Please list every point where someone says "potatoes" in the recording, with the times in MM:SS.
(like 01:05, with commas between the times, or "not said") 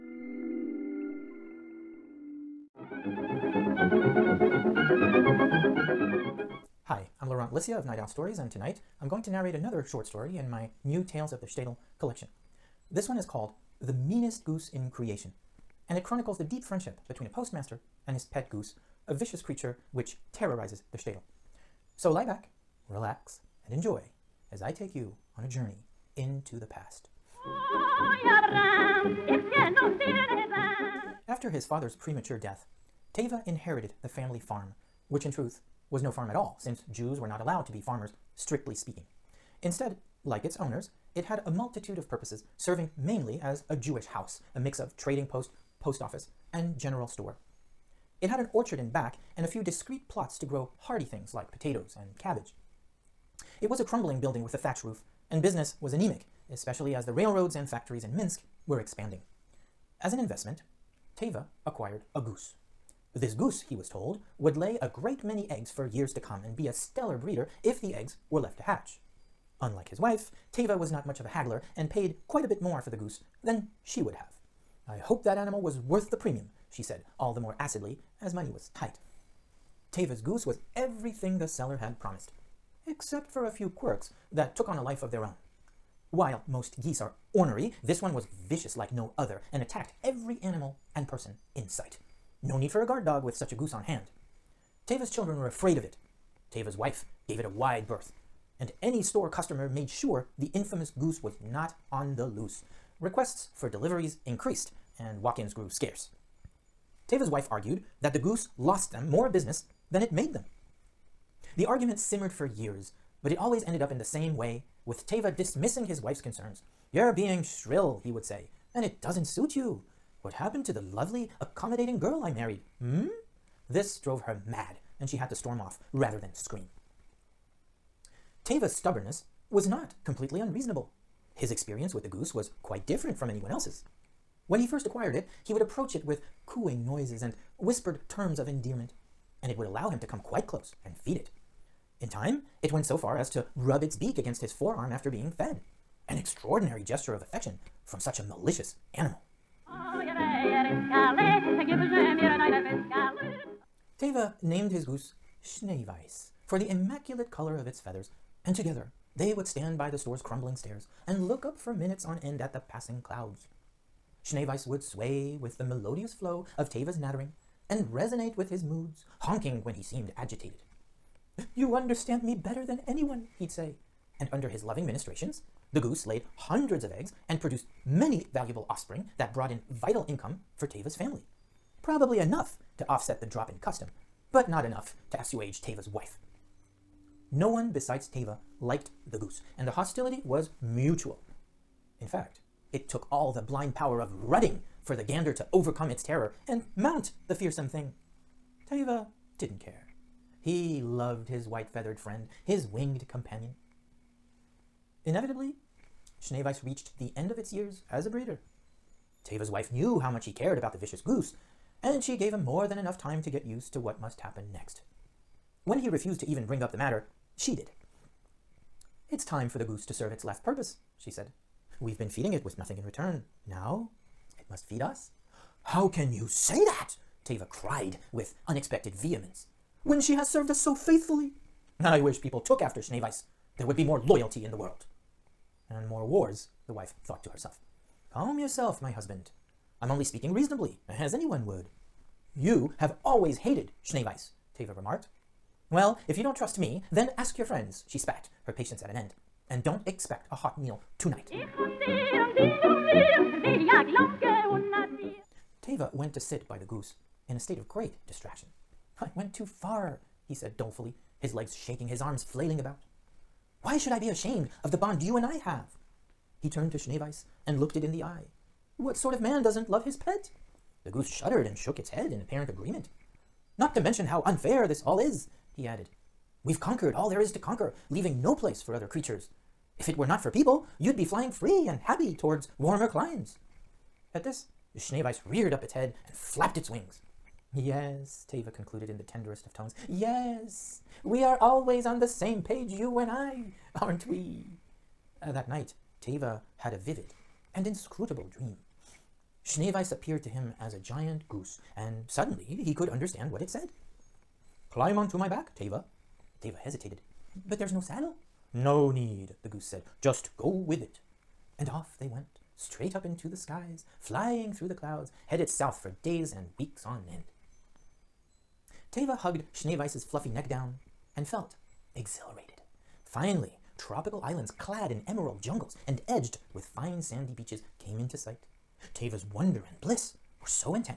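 00:51.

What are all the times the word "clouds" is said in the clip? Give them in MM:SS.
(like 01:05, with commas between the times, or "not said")
02:43, 05:14.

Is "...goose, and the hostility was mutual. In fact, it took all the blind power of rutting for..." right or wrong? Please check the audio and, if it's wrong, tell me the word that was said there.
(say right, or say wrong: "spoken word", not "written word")
right.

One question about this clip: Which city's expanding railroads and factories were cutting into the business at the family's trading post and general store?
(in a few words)
Minsk.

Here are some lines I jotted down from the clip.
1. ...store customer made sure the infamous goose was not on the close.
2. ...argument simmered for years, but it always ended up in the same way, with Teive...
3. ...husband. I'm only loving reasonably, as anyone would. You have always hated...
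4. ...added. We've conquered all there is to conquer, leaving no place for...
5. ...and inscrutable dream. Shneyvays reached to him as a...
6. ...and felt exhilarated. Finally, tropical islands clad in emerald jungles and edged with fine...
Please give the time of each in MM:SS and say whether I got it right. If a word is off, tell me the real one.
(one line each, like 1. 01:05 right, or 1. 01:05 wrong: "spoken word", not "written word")
1. 01:39 wrong: "loose", not "close"
2. 01:51 right
3. 03:58 wrong: "speaking", not "loving"
4. 04:35 right
5. 04:57 wrong: "appeared", not "reached"
6. 05:21 right.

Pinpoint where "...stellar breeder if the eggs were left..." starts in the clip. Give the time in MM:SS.
01:06.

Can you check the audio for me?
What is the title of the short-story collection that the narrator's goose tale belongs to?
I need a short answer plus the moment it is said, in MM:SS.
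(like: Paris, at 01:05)
Tales of the Shtetl, at 00:11.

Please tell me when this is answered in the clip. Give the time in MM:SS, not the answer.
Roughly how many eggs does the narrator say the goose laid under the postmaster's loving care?
02:56.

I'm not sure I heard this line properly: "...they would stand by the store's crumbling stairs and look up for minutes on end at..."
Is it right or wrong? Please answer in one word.
right.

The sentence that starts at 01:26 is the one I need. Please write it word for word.
While most geese are ornery, this one was vicious like no other and attacked every animal and person in sight.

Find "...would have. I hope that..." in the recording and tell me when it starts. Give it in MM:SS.
01:14.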